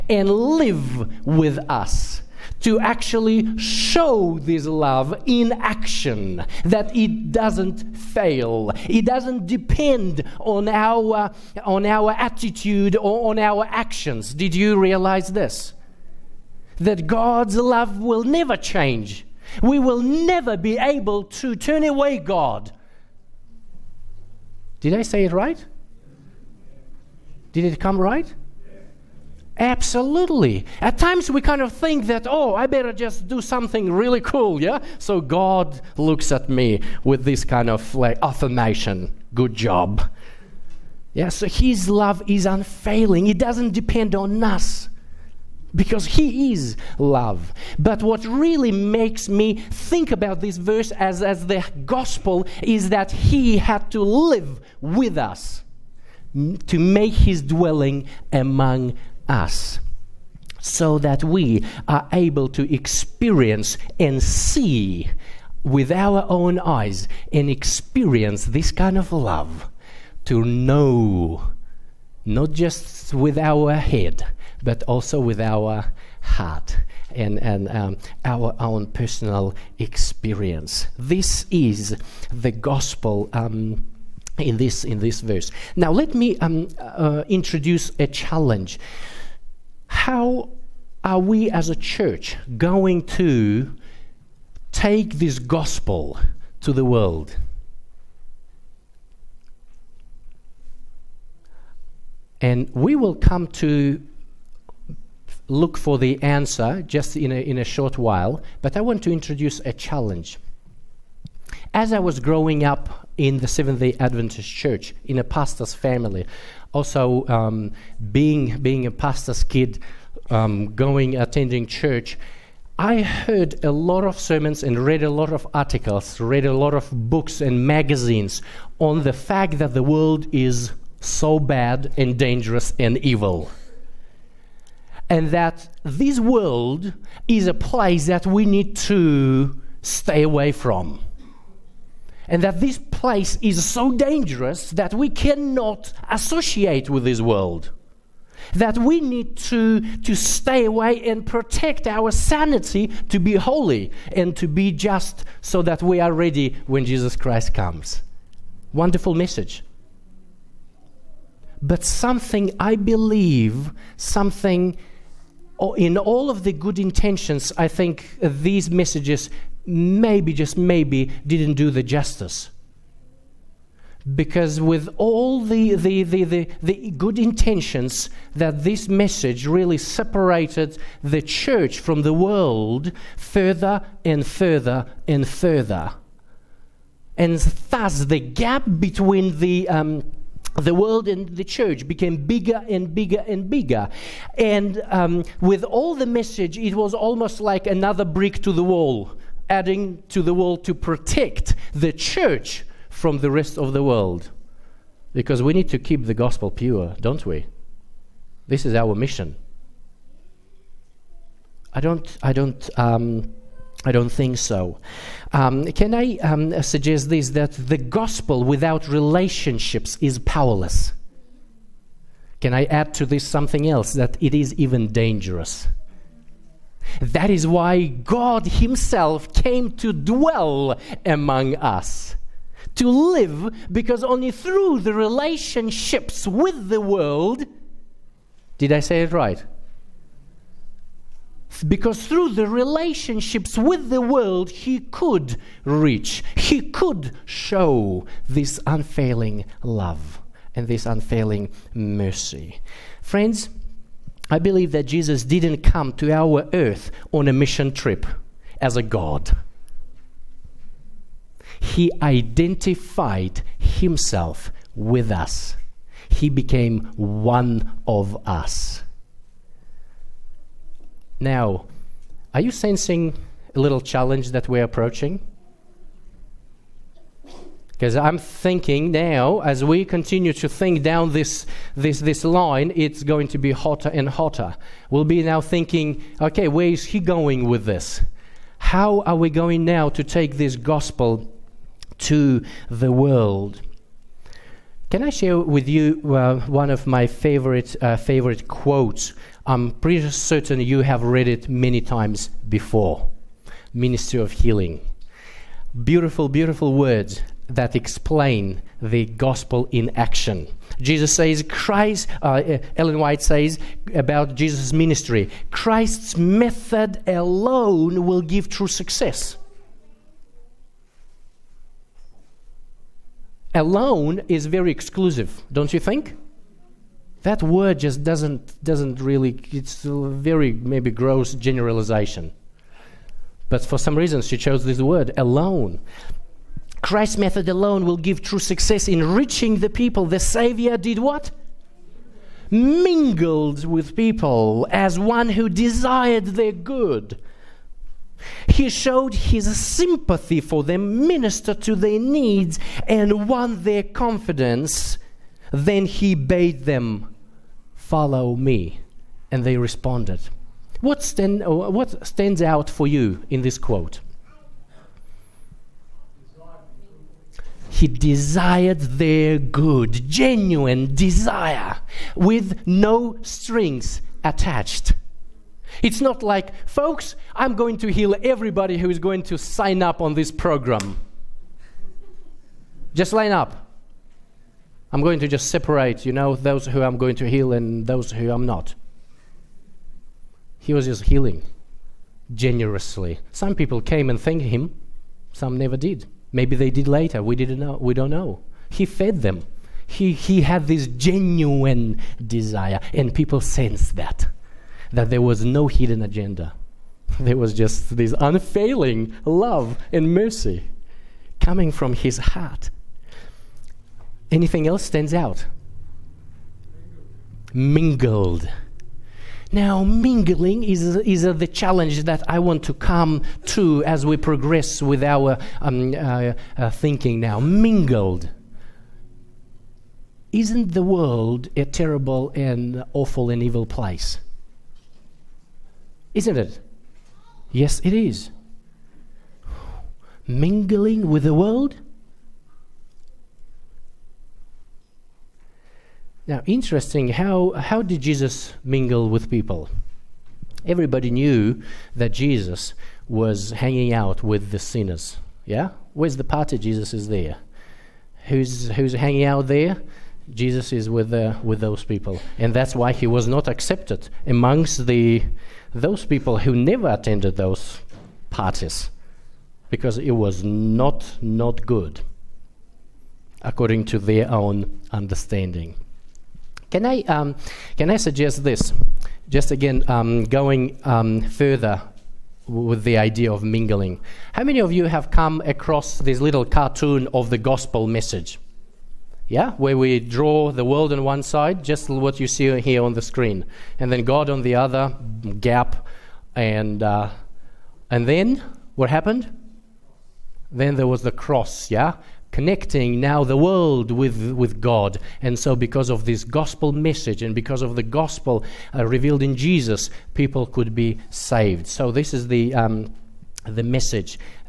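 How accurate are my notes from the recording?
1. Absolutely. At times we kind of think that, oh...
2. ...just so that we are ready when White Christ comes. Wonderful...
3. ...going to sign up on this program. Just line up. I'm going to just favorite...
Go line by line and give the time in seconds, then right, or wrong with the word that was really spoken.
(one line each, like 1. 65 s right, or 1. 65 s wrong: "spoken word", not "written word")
1. 29 s right
2. 154 s wrong: "Jesus", not "White"
3. 378 s wrong: "separate", not "favorite".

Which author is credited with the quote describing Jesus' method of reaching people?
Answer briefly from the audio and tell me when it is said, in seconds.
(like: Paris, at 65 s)
Ellen White, at 312 s.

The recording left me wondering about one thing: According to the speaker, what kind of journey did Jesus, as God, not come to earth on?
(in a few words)
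A mission trip.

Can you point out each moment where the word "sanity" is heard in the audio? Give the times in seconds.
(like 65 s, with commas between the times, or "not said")
152 s.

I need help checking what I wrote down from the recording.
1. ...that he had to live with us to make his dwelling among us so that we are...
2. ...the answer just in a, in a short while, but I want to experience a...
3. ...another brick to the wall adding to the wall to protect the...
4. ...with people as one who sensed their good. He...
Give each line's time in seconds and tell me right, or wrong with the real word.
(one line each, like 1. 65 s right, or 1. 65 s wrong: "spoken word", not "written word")
1. 52 s right
2. 105 s wrong: "introduce", not "experience"
3. 197 s right
4. 343 s wrong: "desired", not "sensed".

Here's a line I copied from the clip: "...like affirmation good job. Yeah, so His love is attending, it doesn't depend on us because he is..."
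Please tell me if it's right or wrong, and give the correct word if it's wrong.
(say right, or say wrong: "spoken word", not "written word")
wrong: "unfailing", not "attending".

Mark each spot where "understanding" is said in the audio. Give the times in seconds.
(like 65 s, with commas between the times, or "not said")
474 s.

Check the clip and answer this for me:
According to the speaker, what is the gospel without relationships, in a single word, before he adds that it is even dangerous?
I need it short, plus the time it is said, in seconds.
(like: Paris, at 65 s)
Powerless, at 220 s.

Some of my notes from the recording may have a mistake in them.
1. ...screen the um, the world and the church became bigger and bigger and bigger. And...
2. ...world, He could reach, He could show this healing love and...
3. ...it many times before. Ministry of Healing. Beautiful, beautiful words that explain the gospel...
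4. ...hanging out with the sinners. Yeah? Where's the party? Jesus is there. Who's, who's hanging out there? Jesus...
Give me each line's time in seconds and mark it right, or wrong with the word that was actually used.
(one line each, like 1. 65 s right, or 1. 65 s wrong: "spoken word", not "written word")
1. 188 s wrong: "between", not "screen"
2. 244 s wrong: "unfailing", not "healing"
3. 301 s right
4. 453 s right.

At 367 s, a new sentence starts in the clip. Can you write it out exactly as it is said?
He desired their good, genuine desire with no strings attached.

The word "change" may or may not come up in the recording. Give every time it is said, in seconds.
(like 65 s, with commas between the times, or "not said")
18 s.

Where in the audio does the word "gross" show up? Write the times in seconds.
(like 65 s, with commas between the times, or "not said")
330 s.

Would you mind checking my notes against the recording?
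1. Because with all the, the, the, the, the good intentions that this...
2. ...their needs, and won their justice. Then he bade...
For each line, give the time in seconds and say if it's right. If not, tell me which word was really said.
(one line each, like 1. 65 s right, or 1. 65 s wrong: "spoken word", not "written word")
1. 174 s right
2. 351 s wrong: "confidence", not "justice".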